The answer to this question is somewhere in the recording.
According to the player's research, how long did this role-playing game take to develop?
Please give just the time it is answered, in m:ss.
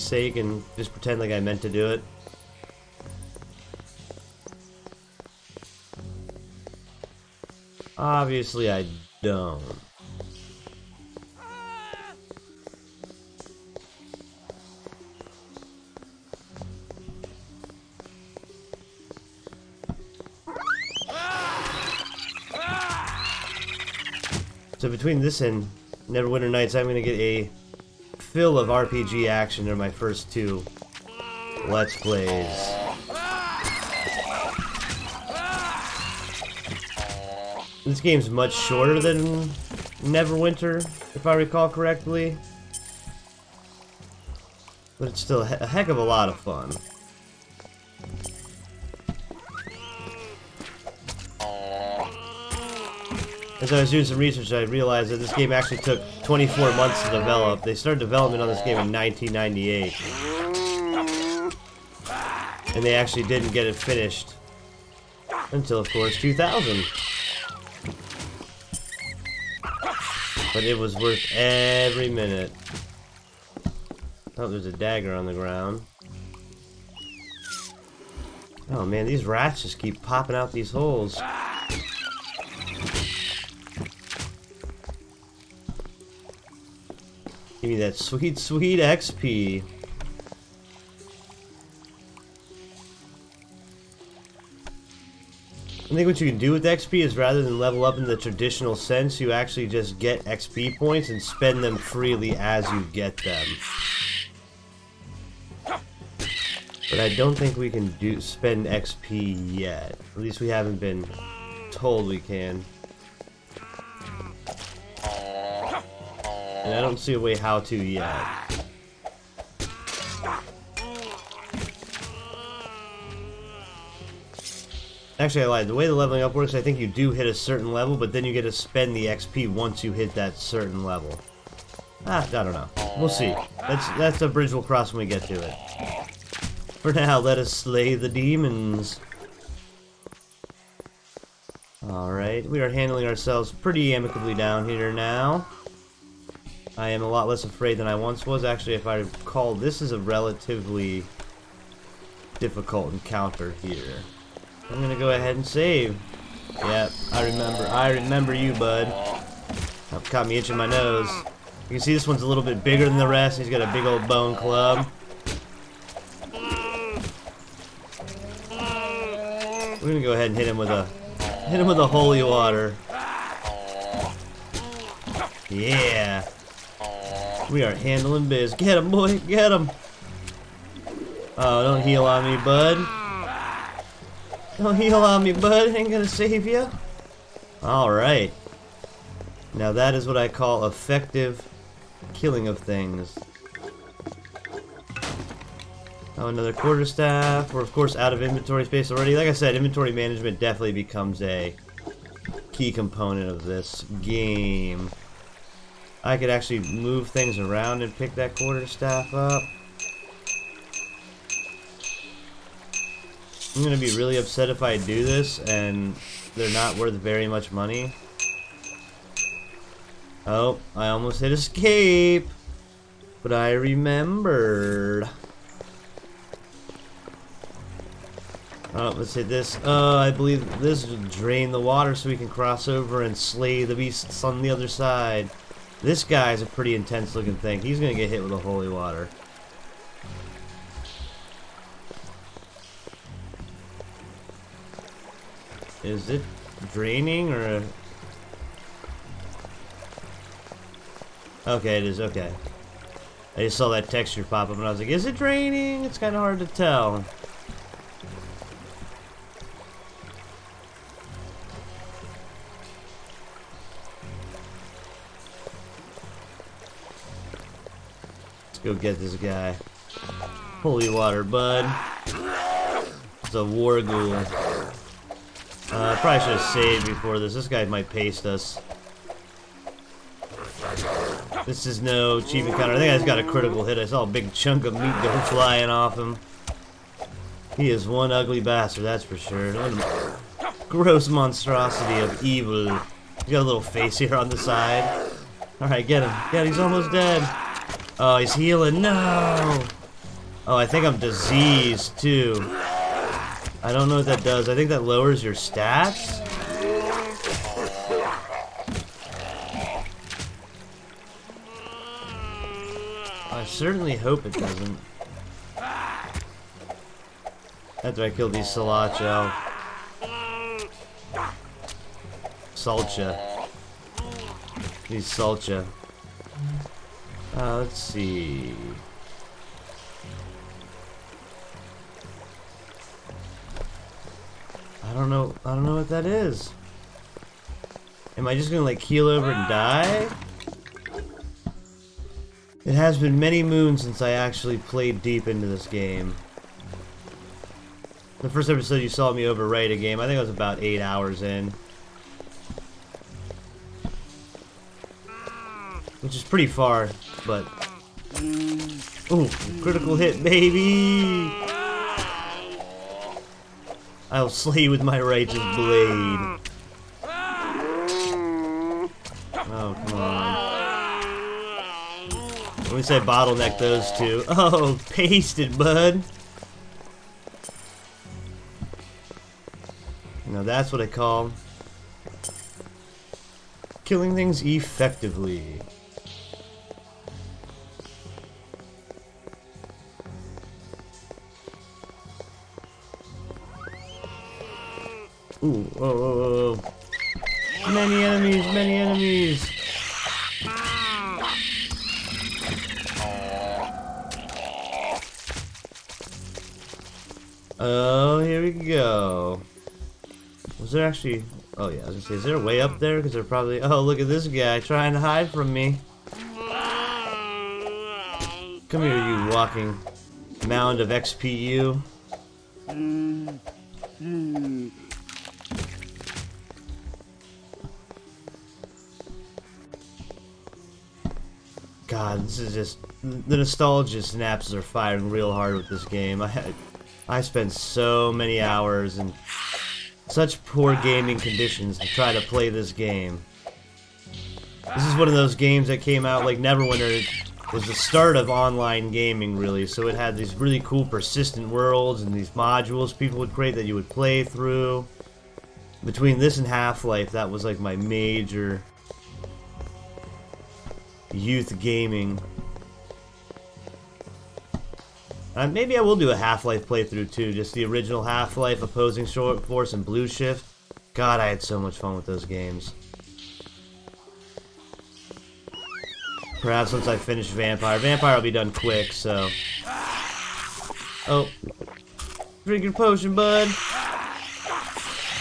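0:56.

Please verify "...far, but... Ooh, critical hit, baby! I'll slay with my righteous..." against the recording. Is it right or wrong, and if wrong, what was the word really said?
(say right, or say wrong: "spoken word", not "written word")
right.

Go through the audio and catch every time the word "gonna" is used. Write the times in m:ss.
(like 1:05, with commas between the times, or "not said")
2:34, 2:49, 3:05, 3:33, 3:57, 5:38, 6:51.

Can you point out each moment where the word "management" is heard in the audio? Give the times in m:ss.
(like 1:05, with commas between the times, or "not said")
3:19.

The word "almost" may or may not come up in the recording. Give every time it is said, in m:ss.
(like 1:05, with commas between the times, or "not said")
3:40, 4:56.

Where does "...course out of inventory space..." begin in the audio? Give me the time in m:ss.
3:17.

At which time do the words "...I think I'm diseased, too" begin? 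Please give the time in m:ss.
5:00.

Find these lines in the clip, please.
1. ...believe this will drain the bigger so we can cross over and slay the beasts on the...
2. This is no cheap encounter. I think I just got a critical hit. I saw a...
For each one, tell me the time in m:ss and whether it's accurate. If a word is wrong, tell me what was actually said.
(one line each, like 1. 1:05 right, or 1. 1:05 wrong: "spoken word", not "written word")
1. 3:50 wrong: "water", not "bigger"
2. 4:41 right.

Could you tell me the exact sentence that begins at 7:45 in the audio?
Uh, maybe I will do a Half-Life playthrough too, just the original Half-Life, Opposing Short Force, and Blue Shift.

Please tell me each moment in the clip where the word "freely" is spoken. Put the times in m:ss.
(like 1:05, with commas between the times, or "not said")
1:41.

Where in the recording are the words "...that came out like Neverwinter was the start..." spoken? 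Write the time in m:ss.
7:25.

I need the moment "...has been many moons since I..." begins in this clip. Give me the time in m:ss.
5:42.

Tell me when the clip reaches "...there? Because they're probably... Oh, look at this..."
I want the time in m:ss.
6:52.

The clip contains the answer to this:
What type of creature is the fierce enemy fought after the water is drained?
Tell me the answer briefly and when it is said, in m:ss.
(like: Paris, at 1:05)
war ghoul, at 4:33.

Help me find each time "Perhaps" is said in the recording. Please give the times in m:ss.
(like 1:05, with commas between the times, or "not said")
7:56.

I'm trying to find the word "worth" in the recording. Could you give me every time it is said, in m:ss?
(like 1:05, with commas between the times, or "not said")
1:10, 3:36.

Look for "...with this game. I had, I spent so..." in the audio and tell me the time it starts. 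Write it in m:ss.
7:15.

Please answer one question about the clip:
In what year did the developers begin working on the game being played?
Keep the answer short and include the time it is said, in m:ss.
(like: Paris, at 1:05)
1998, at 0:58.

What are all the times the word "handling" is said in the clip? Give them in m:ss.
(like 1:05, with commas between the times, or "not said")
2:22, 2:57.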